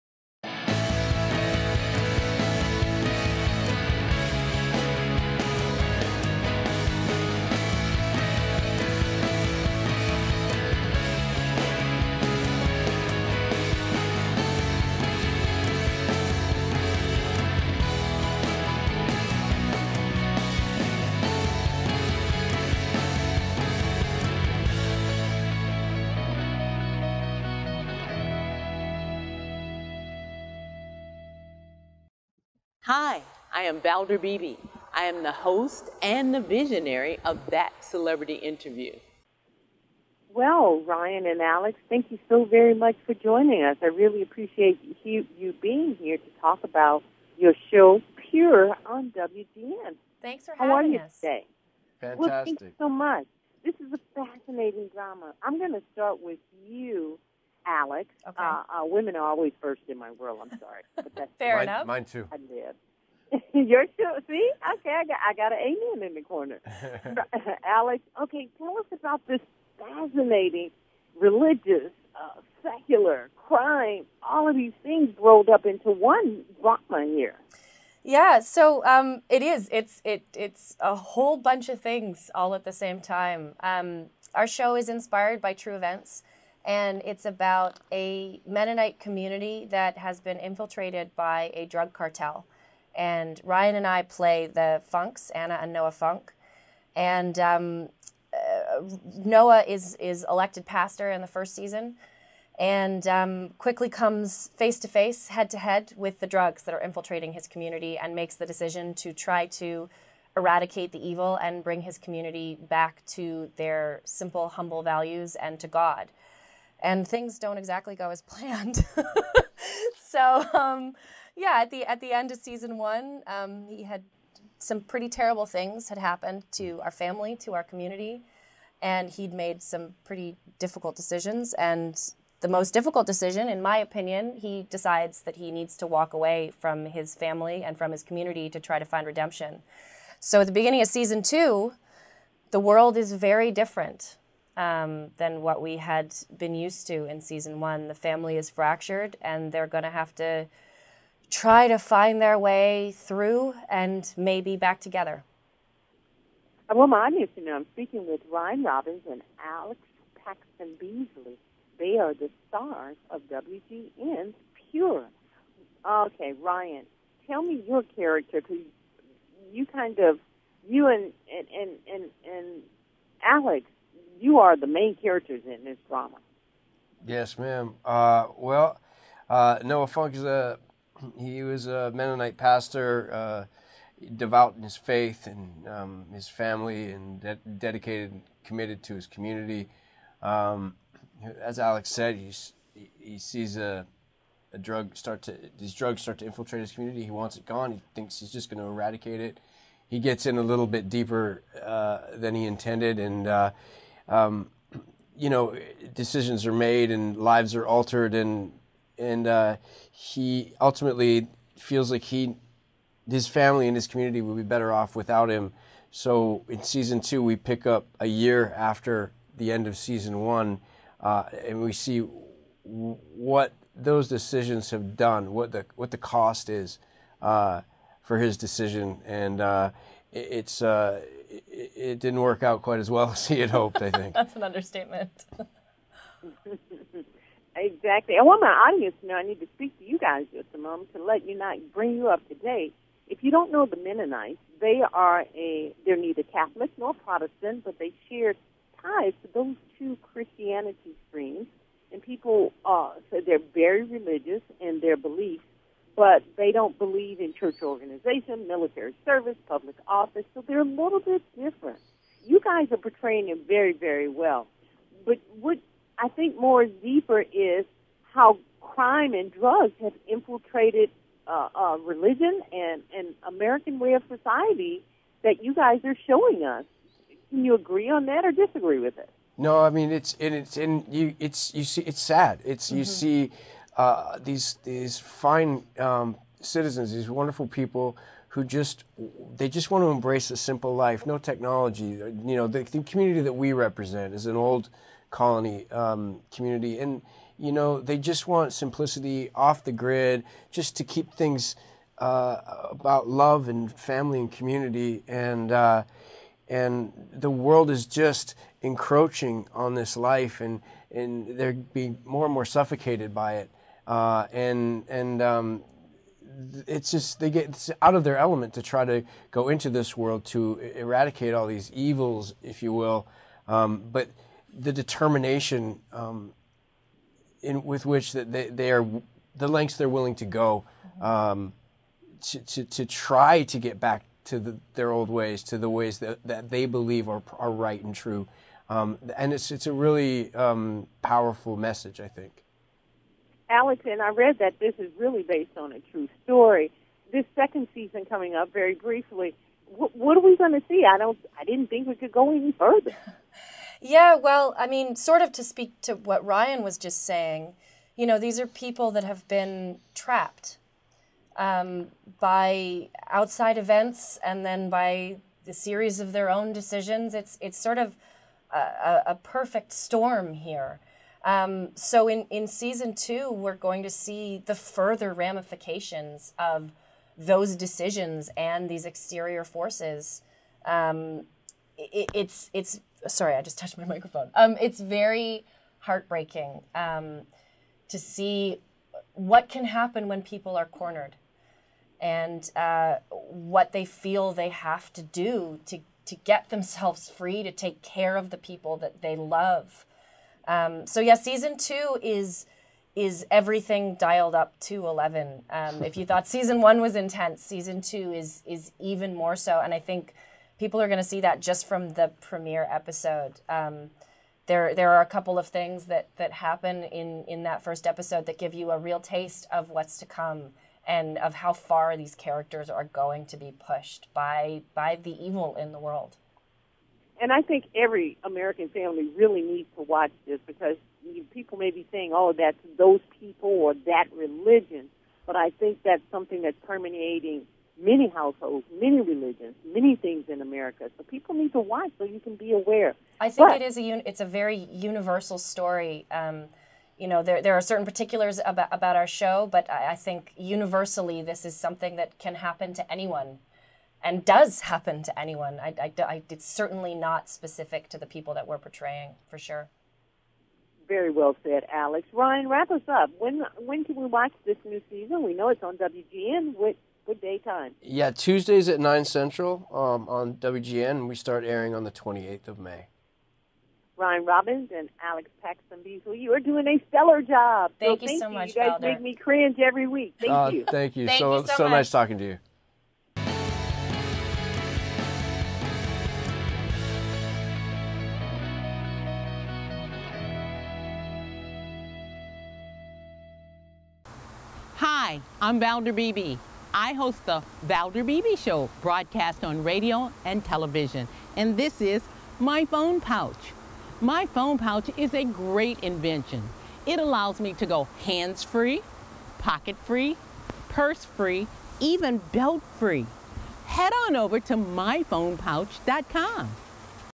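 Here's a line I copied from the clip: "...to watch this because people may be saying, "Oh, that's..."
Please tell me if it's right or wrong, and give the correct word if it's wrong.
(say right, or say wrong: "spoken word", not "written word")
right.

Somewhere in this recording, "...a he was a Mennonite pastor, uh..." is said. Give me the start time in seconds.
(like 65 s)
180 s.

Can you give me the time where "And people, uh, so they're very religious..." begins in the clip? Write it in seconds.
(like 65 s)
251 s.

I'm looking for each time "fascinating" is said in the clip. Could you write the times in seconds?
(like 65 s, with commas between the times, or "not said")
54 s, 69 s.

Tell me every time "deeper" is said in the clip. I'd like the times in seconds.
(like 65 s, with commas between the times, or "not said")
200 s, 266 s.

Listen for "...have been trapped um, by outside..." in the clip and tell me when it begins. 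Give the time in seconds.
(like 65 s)
359 s.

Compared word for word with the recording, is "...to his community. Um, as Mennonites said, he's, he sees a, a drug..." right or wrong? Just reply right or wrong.
wrong.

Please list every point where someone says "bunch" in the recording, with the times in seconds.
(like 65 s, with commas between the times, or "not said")
81 s.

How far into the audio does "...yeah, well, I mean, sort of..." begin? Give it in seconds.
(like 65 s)
353 s.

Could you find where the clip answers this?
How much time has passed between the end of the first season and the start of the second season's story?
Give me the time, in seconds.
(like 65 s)
217 s.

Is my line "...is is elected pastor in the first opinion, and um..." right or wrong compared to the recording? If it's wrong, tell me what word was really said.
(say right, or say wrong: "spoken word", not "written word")
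wrong: "season", not "opinion".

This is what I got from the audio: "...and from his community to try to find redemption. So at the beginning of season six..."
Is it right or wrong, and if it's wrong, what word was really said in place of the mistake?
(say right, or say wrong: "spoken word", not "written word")
wrong: "two", not "six".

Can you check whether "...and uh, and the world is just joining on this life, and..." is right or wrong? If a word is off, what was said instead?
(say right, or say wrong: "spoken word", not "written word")
wrong: "encroaching", not "joining".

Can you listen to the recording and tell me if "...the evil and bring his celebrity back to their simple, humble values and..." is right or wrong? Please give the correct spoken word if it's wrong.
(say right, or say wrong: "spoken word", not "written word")
wrong: "community", not "celebrity".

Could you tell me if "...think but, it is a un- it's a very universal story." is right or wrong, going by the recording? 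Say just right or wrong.
right.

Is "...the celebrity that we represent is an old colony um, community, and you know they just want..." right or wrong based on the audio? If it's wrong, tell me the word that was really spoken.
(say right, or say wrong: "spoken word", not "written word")
wrong: "community", not "celebrity".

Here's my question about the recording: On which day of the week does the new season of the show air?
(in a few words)
Tuesdays.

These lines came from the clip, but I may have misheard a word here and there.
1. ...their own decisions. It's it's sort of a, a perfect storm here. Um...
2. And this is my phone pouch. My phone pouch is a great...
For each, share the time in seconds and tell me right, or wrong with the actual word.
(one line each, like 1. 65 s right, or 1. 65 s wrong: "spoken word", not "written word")
1. 366 s right
2. 501 s right.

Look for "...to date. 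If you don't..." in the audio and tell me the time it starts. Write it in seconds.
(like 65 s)
242 s.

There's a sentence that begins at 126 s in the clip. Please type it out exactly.
our family, to our community, and he'd made some pretty difficult decisions.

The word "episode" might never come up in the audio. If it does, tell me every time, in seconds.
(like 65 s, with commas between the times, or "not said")
412 s, 417 s.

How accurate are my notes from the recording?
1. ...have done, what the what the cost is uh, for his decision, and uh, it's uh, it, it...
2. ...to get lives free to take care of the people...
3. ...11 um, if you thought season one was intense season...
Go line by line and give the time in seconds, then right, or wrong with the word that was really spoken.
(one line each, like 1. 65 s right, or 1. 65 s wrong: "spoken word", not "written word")
1. 224 s right
2. 396 s wrong: "themselves", not "lives"
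3. 404 s right.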